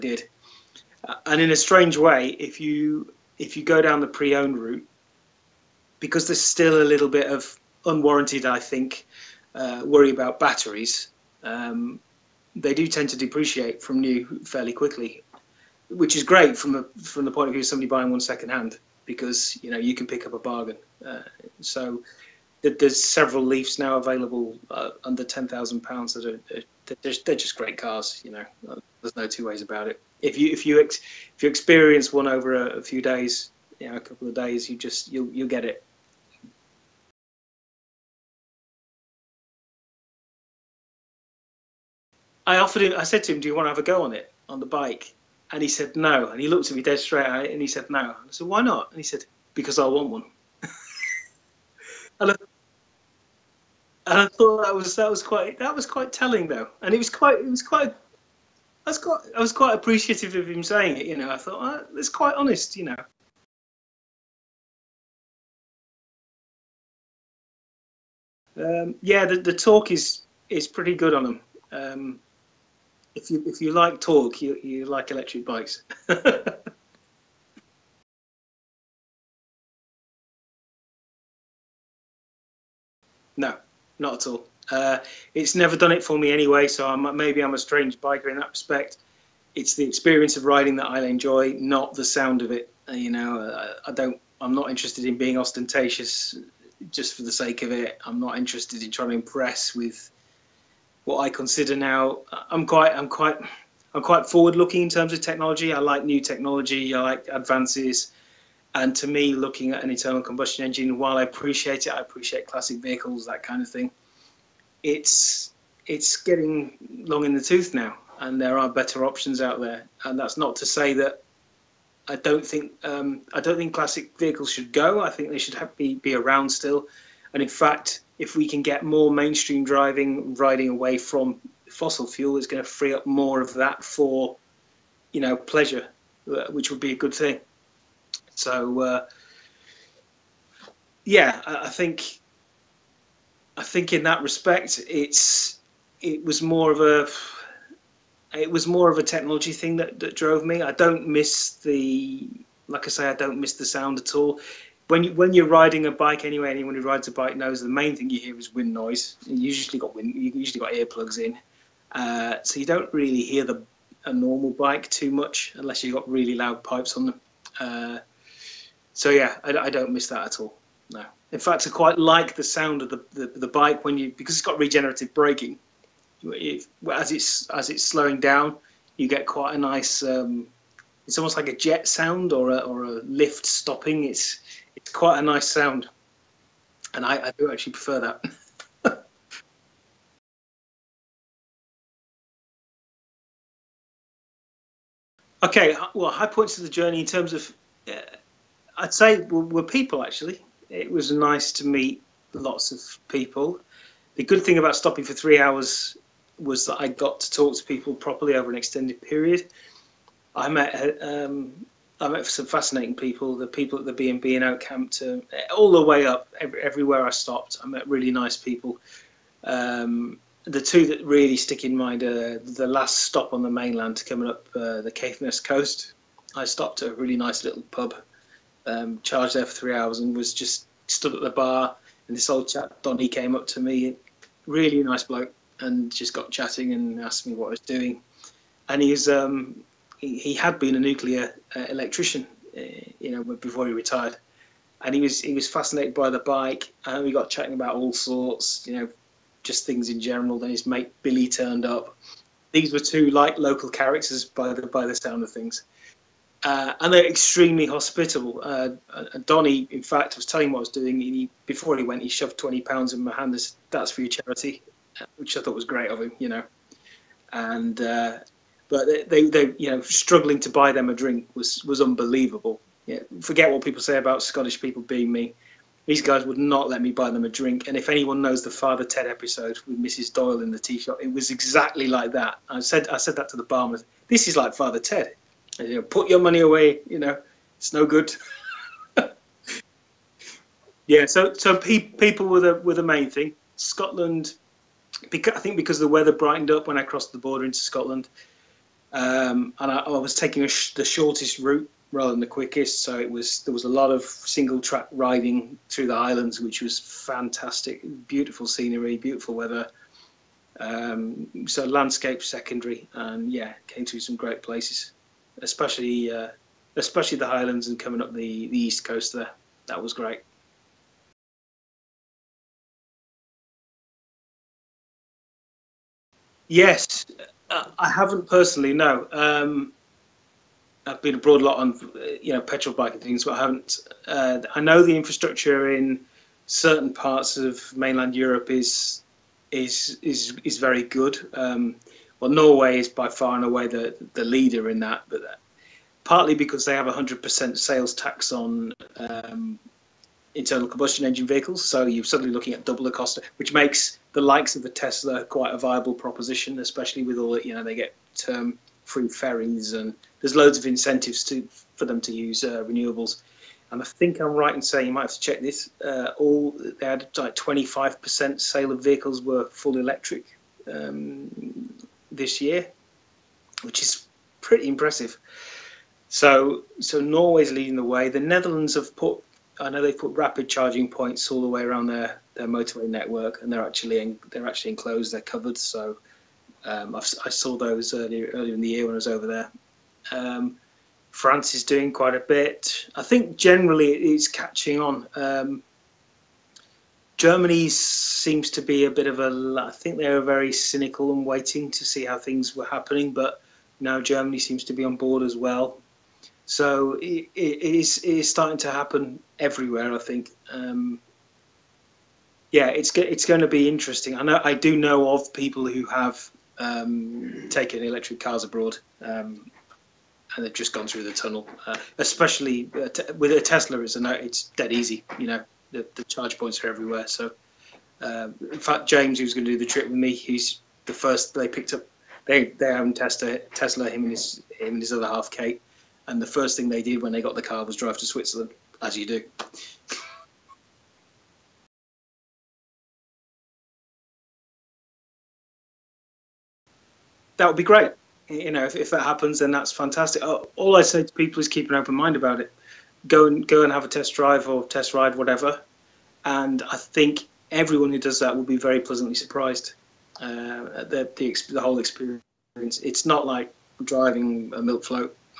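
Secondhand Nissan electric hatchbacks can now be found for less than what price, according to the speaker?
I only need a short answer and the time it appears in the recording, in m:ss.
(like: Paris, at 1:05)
£10,000, at 0:25.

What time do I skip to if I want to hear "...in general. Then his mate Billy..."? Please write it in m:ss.
4:09.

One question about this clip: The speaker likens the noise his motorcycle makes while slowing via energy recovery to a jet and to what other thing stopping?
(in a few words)
a lift.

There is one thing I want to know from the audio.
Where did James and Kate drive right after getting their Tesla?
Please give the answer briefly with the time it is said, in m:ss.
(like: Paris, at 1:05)
Switzerland, at 7:18.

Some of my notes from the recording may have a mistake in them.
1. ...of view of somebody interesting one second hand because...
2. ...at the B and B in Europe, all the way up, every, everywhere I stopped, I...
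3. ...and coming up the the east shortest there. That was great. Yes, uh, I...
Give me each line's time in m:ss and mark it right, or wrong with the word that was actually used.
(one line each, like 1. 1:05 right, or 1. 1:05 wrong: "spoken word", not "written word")
1. 0:17 wrong: "buying", not "interesting"
2. 3:33 wrong: "Okehampton", not "Europe"
3. 5:17 wrong: "coast", not "shortest".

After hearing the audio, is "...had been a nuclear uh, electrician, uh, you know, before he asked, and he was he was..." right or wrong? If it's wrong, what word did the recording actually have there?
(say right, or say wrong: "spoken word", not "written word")
wrong: "retired", not "asked".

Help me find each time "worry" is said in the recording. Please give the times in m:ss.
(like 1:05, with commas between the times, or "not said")
0:09.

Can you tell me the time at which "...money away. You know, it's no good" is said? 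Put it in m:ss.
4:46.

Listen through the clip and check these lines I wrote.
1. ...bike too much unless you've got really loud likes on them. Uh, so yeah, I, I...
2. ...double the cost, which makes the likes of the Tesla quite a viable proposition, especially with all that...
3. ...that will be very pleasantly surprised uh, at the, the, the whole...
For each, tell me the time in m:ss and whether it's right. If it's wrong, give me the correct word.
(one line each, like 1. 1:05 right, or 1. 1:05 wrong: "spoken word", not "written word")
1. 2:44 wrong: "pipes", not "likes"
2. 5:52 right
3. 7:38 right.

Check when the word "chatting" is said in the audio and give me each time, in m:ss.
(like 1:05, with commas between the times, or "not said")
3:56, 4:07.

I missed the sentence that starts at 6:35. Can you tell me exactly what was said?
Um, Germany seems to be a bit of a.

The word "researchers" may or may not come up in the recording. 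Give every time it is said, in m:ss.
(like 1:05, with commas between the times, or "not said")
not said.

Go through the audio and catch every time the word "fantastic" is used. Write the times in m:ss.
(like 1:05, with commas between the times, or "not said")
5:06, 7:29.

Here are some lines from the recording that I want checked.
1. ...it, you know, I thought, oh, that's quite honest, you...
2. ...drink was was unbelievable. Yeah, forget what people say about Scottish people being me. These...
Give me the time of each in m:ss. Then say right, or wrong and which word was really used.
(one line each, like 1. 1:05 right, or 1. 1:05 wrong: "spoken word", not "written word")
1. 1:00 right
2. 4:30 right.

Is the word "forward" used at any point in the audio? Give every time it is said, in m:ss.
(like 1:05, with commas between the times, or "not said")
1:44.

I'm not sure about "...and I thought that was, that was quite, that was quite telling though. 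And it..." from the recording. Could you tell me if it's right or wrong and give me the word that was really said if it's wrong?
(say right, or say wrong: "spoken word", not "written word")
right.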